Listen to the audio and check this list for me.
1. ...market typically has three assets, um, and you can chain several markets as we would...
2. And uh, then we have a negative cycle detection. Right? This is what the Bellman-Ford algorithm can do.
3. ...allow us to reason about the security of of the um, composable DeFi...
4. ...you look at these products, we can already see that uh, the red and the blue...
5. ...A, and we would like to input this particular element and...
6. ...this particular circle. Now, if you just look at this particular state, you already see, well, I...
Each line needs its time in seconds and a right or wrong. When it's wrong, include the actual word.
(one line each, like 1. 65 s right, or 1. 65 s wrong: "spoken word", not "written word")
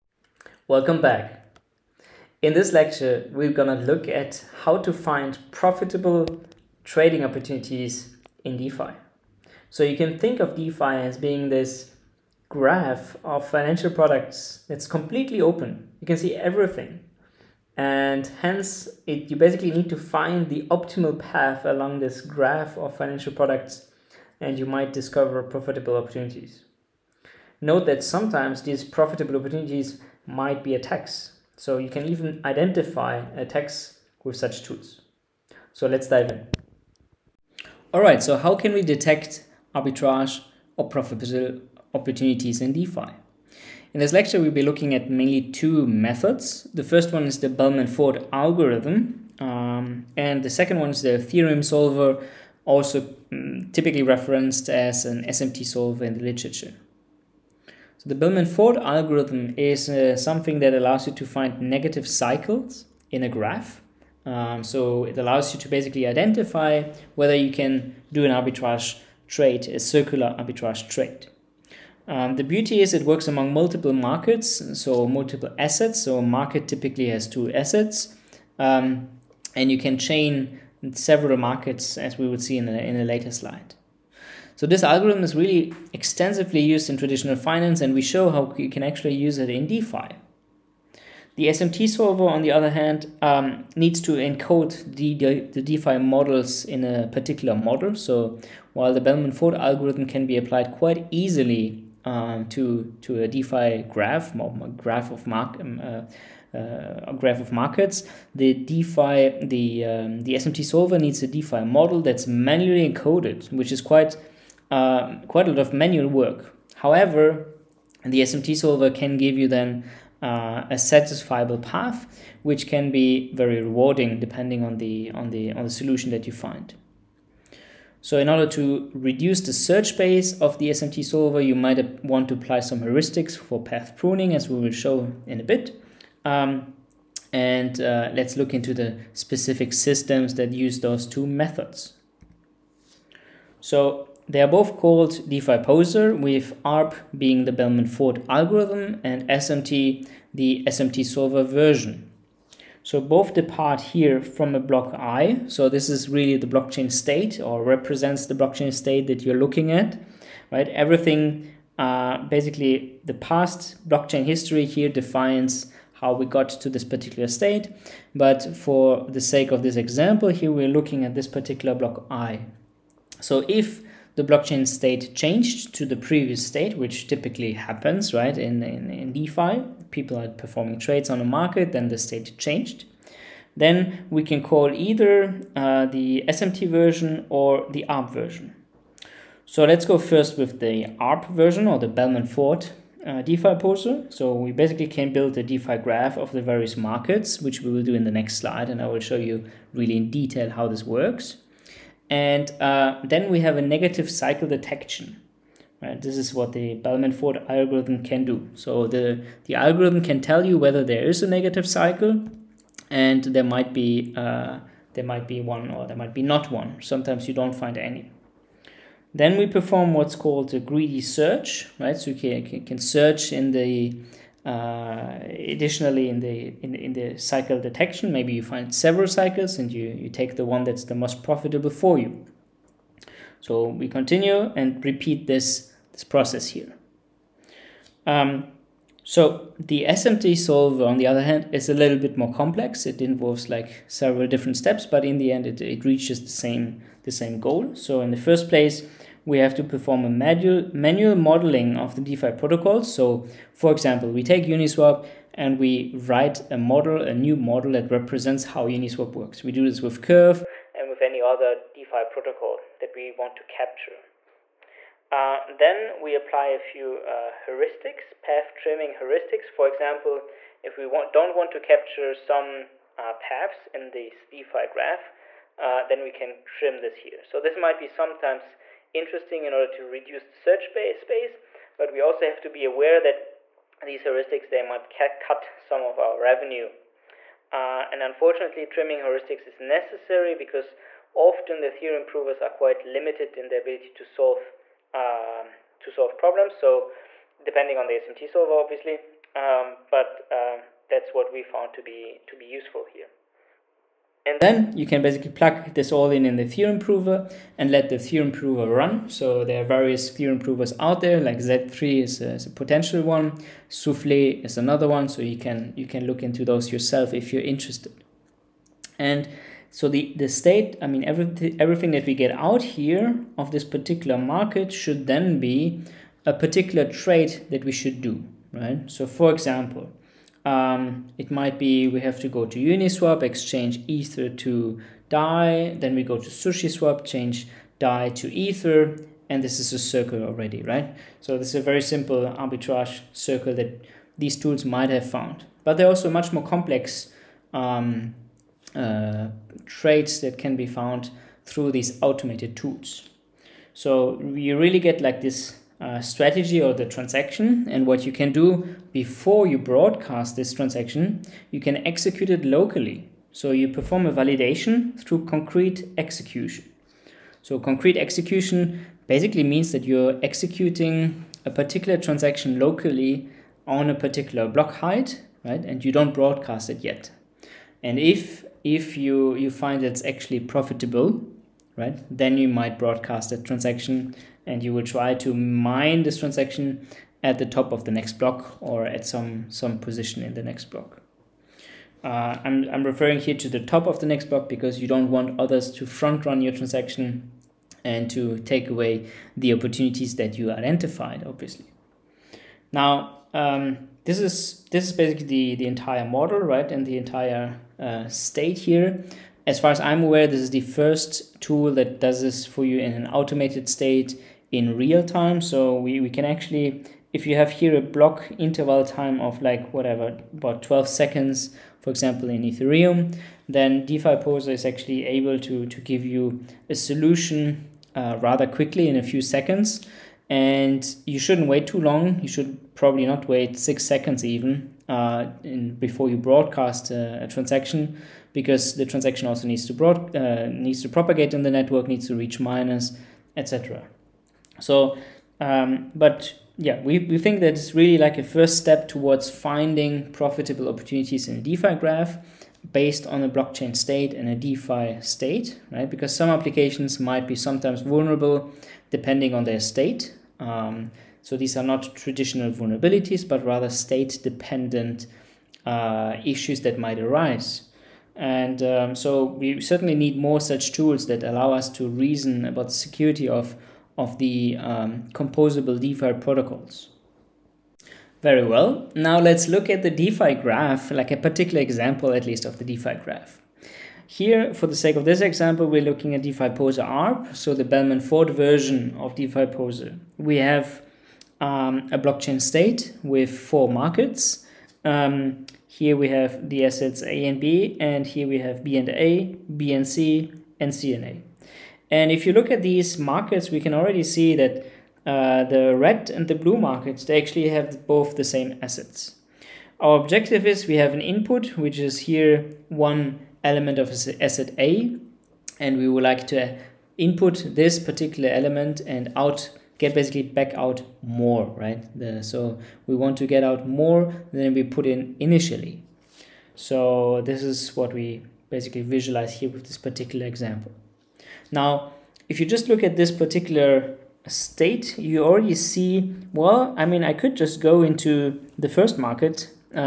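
1. 76 s wrong: "two", not "three"
2. 202 s right
3. 471 s right
4. 502 s wrong: "markets", not "products"
5. 514 s right
6. 529 s wrong: "example", not "circle".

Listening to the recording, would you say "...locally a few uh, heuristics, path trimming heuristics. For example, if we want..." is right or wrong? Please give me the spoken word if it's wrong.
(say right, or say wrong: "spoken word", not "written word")
wrong: "apply", not "locally".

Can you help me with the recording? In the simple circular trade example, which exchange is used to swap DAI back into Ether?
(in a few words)
SushiSwap.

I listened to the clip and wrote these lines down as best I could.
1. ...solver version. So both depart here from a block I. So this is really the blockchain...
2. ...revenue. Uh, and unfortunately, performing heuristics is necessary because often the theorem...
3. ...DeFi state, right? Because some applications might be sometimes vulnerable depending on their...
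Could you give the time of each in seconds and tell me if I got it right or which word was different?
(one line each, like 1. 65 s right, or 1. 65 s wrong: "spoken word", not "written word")
1. 151 s right
2. 286 s wrong: "trimming", not "performing"
3. 454 s right.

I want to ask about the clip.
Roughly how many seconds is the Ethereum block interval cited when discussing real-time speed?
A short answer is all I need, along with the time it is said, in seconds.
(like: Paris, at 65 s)
12, at 420 s.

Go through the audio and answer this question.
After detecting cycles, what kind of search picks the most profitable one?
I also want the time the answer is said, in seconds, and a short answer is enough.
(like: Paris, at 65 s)
greedy search, at 220 s.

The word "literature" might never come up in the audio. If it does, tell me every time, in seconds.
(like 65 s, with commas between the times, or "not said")
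56 s.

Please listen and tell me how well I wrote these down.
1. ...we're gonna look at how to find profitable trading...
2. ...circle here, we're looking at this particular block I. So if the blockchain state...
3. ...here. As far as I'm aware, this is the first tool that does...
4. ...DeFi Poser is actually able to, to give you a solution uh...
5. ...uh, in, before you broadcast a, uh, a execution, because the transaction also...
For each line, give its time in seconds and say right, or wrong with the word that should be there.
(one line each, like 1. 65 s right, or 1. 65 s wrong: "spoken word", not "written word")
1. 3 s right
2. 169 s wrong: "example", not "circle"
3. 408 s right
4. 423 s right
5. 434 s wrong: "transaction", not "execution".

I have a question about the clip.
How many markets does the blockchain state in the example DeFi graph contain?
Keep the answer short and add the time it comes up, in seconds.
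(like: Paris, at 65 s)
4, at 493 s.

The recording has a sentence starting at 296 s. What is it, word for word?
So depending on the SMT solver, obviously, um, but um, that's what we found to be to be useful here.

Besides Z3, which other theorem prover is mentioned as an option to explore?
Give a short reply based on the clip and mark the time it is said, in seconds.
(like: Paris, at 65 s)
Souffle, at 313 s.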